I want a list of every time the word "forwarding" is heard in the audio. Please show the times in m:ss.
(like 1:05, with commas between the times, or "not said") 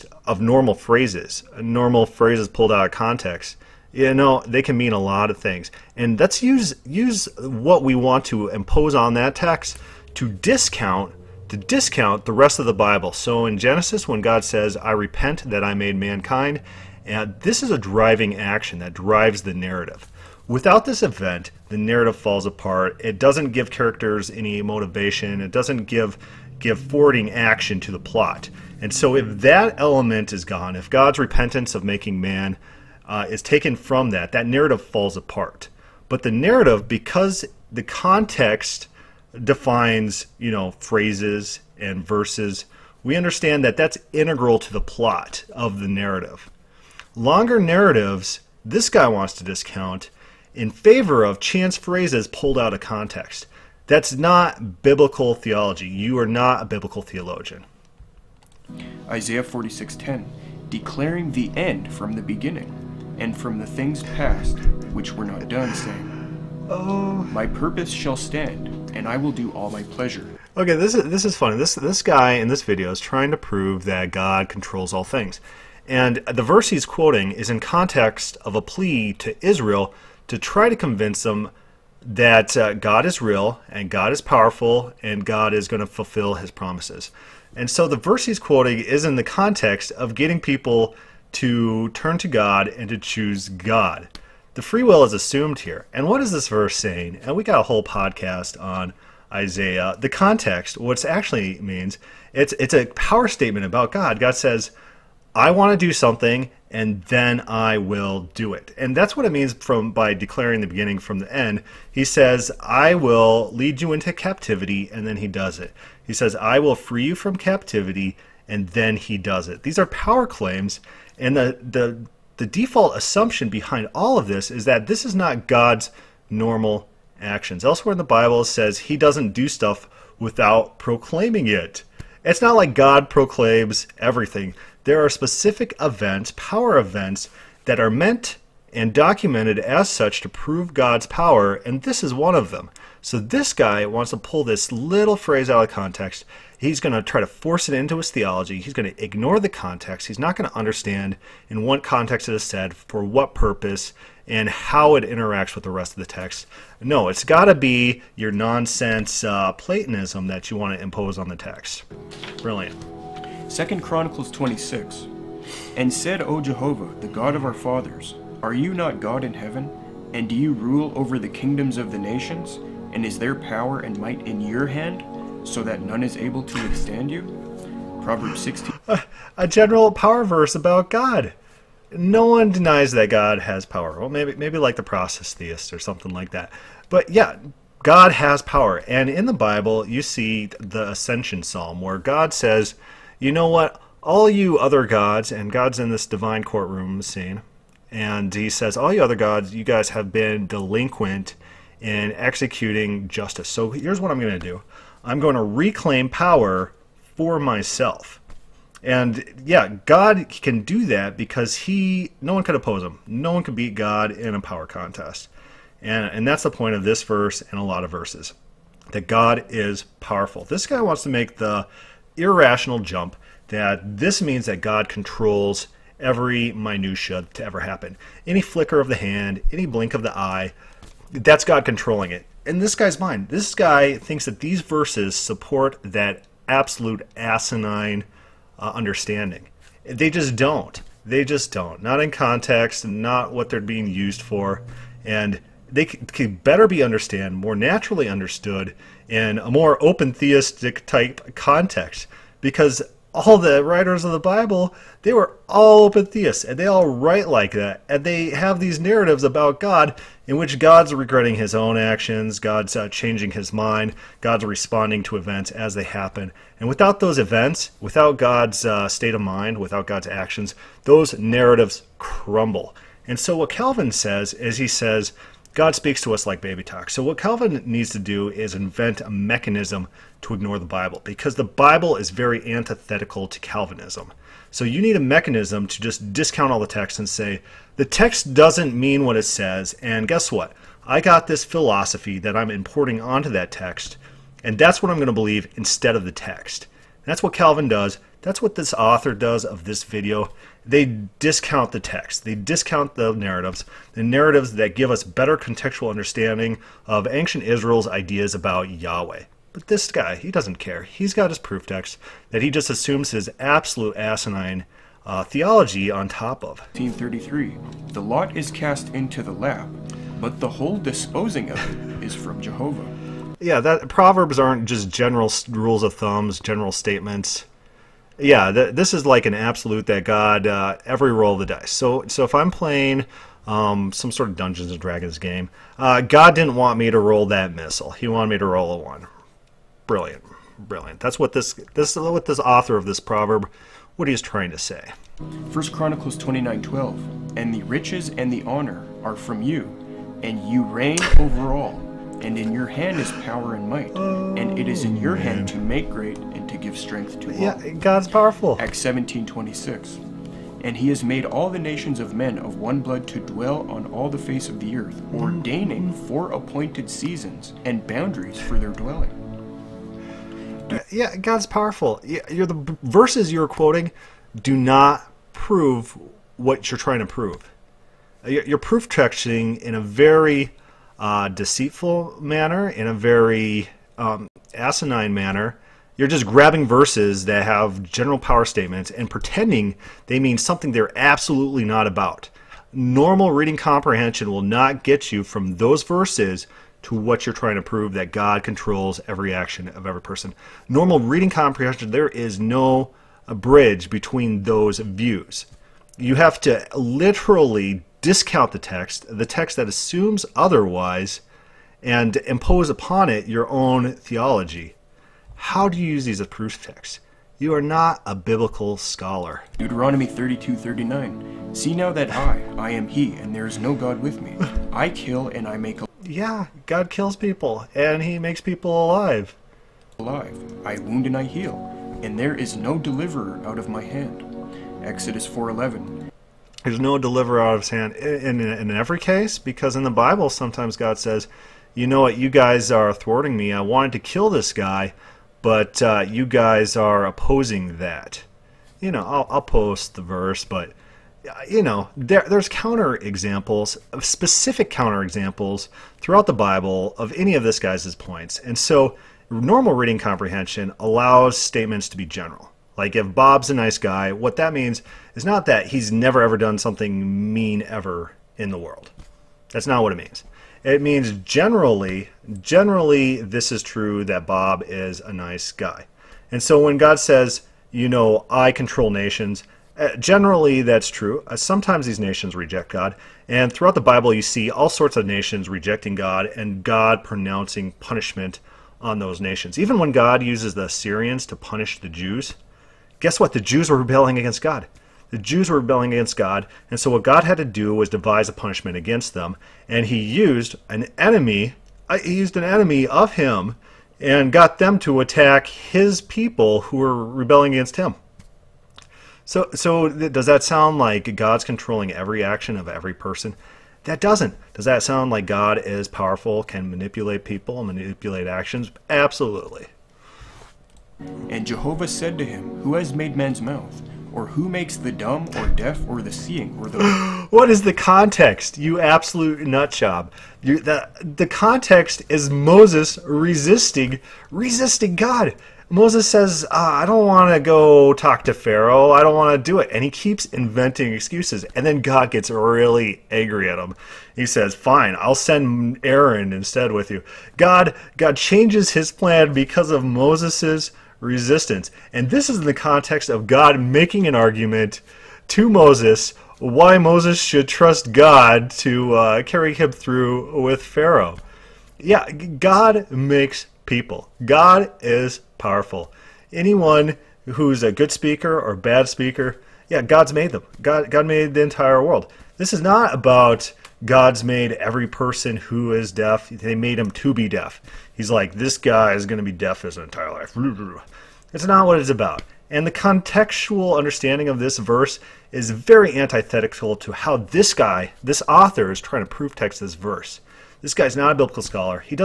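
0:26.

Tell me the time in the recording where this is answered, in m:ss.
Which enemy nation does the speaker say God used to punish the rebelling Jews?
8:10.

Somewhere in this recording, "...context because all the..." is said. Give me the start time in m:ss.
4:11.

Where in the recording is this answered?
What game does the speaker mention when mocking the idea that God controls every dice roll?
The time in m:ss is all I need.
5:34.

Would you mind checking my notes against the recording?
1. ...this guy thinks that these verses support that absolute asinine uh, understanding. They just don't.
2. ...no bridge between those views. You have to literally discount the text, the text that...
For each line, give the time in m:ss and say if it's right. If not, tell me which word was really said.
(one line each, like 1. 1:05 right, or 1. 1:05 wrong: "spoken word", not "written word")
1. 3:53 right
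2. 6:42 right.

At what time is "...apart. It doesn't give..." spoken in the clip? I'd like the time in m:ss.
0:22.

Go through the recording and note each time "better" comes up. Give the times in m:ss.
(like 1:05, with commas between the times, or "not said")
4:06, 5:05.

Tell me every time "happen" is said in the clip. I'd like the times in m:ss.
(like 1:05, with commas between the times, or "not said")
3:47, 4:25.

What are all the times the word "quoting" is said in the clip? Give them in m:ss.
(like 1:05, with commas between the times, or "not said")
1:16, 1:28, 6:13.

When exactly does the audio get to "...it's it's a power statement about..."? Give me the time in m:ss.
1:42.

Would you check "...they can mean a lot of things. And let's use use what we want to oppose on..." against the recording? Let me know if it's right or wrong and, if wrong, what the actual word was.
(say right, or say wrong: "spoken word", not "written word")
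wrong: "impose", not "oppose".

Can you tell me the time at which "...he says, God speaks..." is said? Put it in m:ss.
4:34.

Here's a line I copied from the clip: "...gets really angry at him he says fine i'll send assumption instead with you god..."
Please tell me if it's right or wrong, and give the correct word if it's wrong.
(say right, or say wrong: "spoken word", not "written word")
wrong: "aaron", not "assumption".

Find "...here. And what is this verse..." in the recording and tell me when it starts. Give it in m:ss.
1:35.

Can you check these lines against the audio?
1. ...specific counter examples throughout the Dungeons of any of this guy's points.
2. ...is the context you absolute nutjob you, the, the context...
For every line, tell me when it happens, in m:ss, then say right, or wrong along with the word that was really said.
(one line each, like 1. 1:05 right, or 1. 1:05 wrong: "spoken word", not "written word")
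1. 7:34 wrong: "Bible", not "Dungeons"
2. 8:47 right.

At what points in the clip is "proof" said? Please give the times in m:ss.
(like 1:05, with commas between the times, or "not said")
5:11, 6:18, 6:56, 9:49.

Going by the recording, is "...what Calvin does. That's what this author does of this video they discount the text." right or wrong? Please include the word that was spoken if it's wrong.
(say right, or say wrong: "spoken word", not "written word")
right.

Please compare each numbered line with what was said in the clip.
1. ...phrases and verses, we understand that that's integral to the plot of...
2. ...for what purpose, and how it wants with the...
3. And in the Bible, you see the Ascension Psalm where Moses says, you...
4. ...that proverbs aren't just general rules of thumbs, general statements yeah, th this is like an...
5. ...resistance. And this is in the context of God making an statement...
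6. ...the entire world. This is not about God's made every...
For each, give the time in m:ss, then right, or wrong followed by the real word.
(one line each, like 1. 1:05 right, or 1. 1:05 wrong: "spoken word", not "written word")
1. 0:40 right
2. 2:32 wrong: "interacts", not "wants"
3. 3:08 wrong: "God", not "Moses"
4. 5:23 right
5. 9:11 wrong: "argument", not "statement"
6. 9:31 right.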